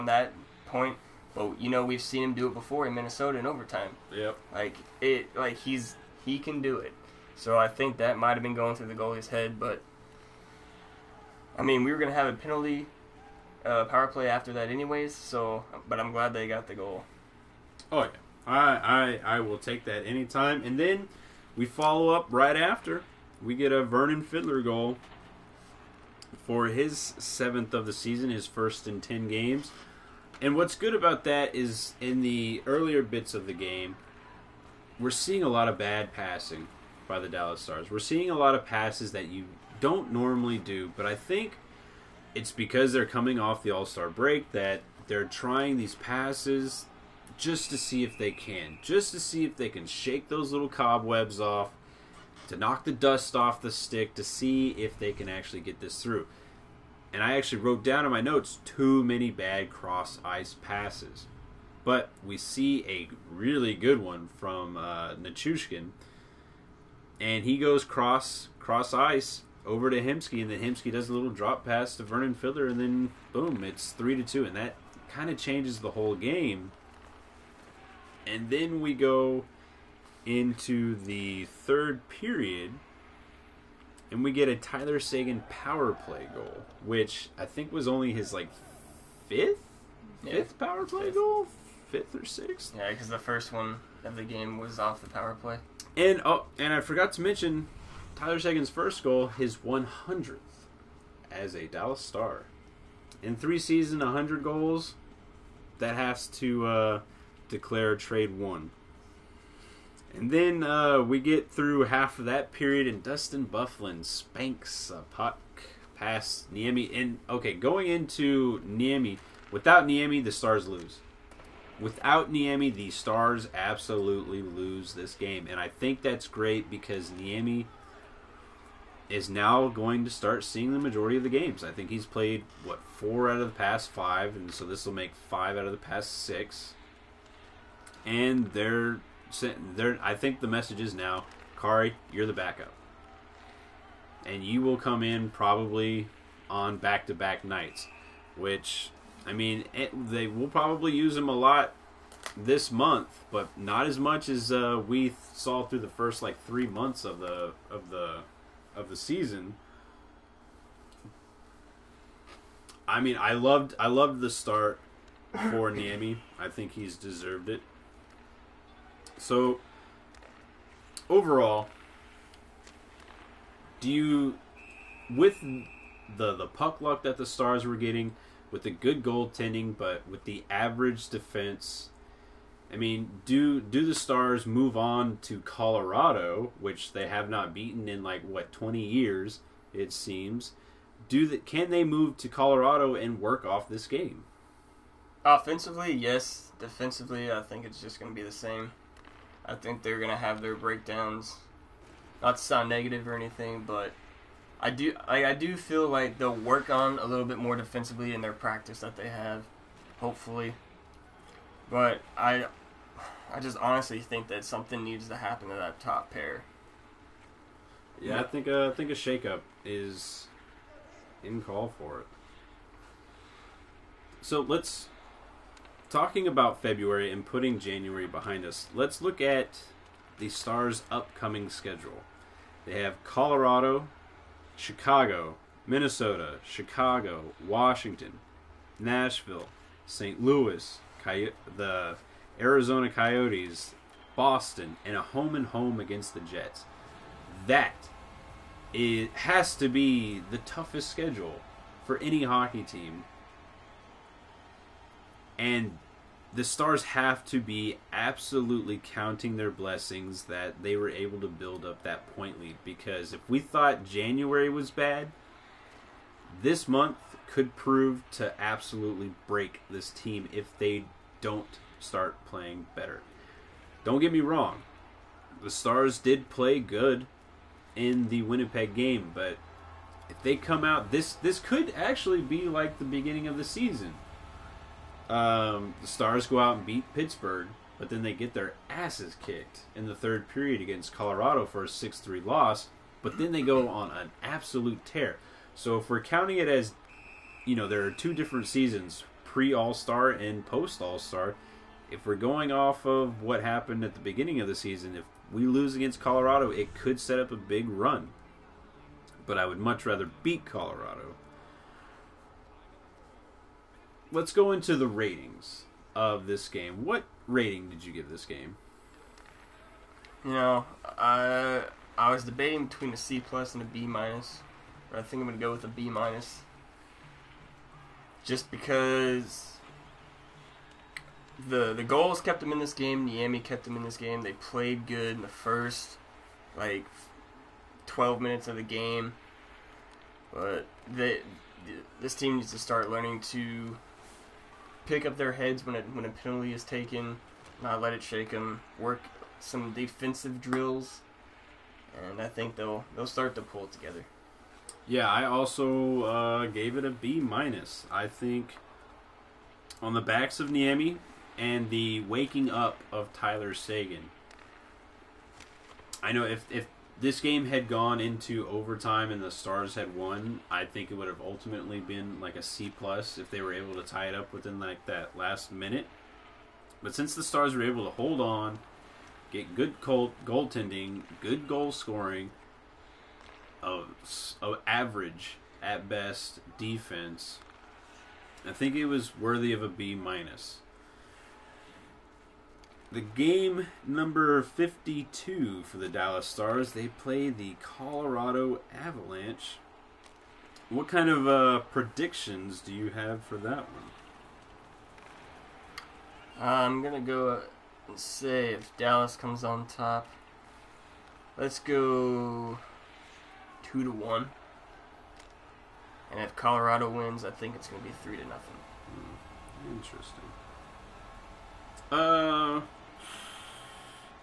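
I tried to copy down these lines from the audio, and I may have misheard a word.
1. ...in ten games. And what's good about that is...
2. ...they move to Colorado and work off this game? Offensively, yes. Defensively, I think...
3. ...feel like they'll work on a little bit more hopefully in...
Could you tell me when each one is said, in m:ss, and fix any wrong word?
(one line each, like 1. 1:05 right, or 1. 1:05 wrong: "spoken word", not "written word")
1. 0:28 right
2. 3:11 right
3. 3:25 wrong: "defensively", not "hopefully".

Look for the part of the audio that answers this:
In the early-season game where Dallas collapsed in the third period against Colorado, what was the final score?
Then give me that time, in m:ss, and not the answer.
4:51.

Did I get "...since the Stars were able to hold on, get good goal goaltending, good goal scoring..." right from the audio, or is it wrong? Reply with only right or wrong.
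right.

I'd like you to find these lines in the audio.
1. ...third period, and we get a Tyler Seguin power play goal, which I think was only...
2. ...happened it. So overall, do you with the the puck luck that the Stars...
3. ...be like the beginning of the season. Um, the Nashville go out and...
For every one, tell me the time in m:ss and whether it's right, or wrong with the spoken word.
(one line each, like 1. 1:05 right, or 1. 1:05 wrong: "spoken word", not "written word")
1. 1:21 right
2. 2:46 wrong: "deserved", not "happened"
3. 4:42 wrong: "Stars", not "Nashville".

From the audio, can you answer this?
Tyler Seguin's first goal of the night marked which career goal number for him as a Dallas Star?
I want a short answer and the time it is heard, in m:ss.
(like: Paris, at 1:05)
100th, at 1:39.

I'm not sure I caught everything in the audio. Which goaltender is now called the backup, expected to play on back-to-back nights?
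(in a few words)
Kari.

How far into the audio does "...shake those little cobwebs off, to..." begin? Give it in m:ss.
0:49.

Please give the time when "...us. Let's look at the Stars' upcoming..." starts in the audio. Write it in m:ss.
3:48.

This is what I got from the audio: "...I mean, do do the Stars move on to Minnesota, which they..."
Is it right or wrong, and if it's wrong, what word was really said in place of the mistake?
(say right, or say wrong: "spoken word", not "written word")
wrong: "Colorado", not "Minnesota".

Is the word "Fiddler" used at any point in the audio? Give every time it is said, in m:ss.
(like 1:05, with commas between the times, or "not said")
0:24, 1:12.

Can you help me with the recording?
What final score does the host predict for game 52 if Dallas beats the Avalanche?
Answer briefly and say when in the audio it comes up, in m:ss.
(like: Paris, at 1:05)
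2-1, at 6:53.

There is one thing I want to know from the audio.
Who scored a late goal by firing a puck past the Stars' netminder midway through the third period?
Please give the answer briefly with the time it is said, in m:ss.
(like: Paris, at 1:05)
Dustin Byfuglien, at 1:53.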